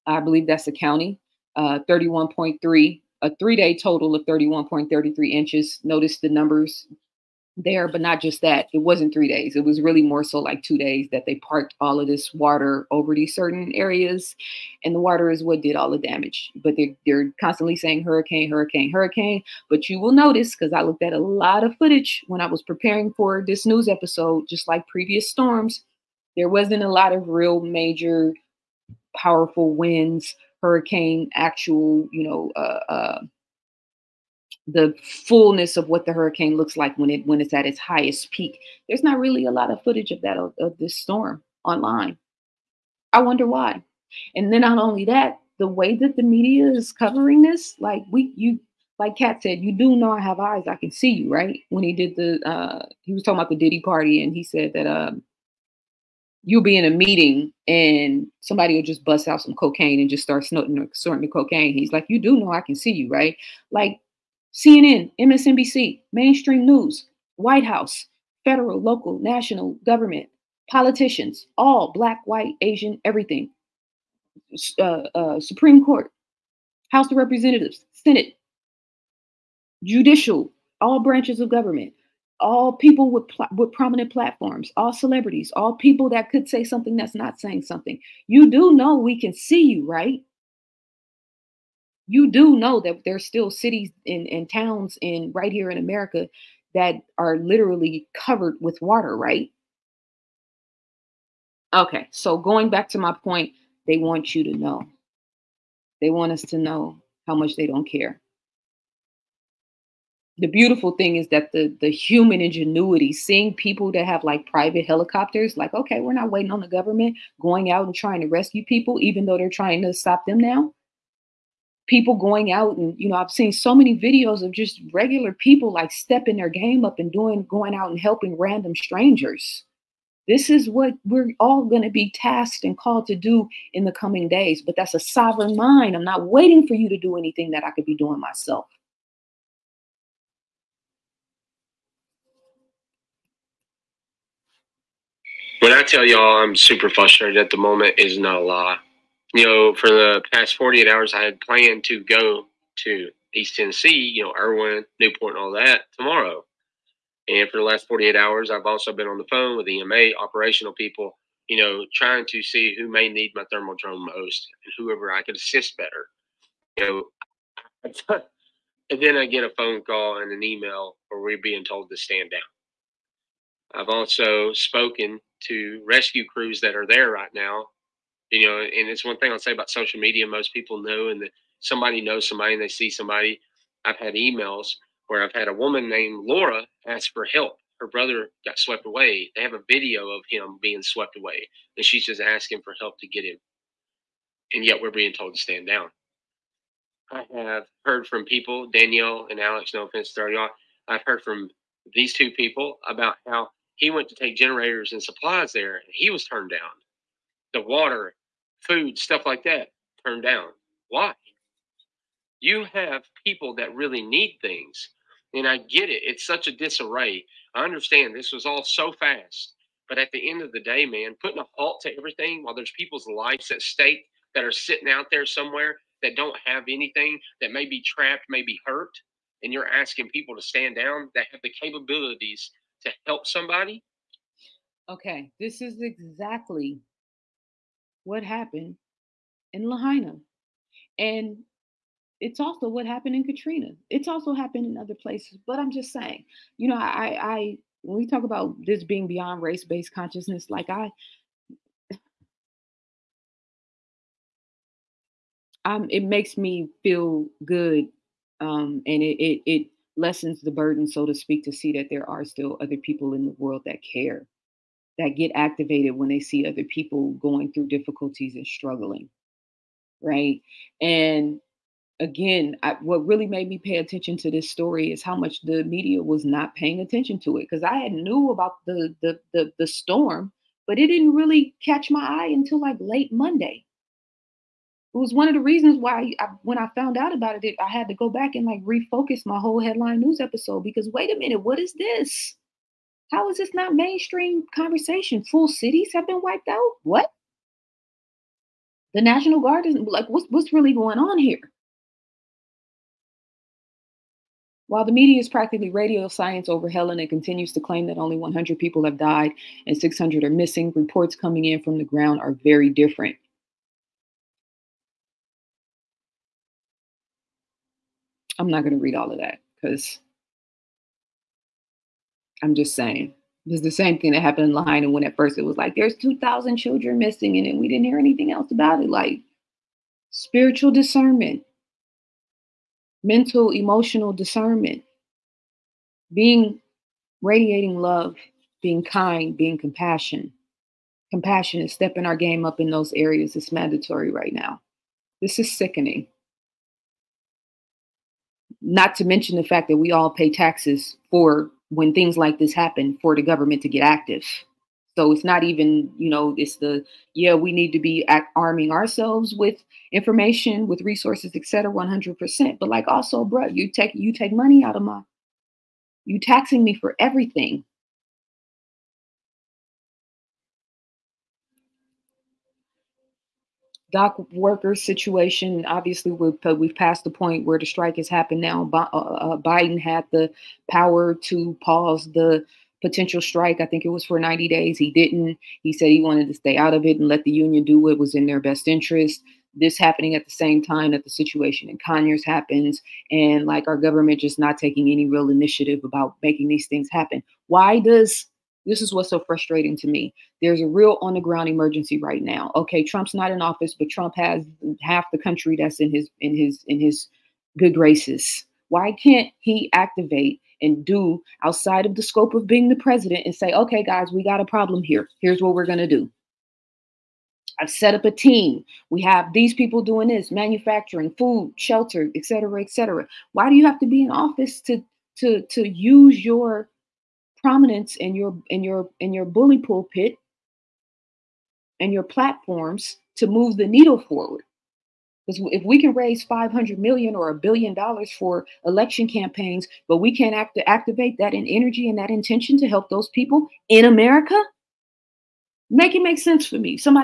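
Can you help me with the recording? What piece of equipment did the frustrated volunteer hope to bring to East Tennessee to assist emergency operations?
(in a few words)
thermal drone.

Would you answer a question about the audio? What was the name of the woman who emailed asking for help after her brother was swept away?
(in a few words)
Laura.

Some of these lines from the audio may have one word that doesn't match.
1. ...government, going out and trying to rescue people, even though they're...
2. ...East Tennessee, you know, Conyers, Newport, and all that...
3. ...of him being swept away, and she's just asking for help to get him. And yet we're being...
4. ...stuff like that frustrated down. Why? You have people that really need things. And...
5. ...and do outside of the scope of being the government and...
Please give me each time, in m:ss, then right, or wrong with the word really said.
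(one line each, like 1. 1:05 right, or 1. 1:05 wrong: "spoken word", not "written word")
1. 1:56 right
2. 2:33 wrong: "Erwin", not "Conyers"
3. 3:10 right
4. 3:28 wrong: "turned", not "frustrated"
5. 6:50 wrong: "president", not "government".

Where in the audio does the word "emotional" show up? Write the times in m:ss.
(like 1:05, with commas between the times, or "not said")
5:33.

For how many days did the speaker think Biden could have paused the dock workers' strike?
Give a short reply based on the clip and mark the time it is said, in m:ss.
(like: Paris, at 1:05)
90, at 6:24.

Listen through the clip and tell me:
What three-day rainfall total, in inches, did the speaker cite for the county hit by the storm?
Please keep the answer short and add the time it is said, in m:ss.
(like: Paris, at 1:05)
31.33 inches, at 0:04.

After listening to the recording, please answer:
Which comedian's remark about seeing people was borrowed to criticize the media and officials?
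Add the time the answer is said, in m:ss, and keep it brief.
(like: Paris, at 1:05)
Katt, at 0:49.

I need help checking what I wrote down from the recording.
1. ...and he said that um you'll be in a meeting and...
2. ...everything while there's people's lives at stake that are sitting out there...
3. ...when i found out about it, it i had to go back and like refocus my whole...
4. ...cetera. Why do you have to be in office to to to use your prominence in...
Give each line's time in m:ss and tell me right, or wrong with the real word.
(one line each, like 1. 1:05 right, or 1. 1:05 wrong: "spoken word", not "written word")
1. 0:54 right
2. 3:41 right
3. 4:46 right
4. 7:02 right.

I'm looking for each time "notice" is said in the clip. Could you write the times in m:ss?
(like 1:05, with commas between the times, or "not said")
0:05, 0:20.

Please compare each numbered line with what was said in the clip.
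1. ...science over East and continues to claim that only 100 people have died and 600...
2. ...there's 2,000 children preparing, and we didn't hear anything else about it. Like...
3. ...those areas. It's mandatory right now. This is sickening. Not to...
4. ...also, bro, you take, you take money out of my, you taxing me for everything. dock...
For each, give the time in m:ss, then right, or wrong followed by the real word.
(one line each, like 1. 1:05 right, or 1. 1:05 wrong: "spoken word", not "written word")
1. 5:06 wrong: "Helene", not "East"
2. 5:25 wrong: "missing", not "preparing"
3. 5:42 right
4. 6:02 right.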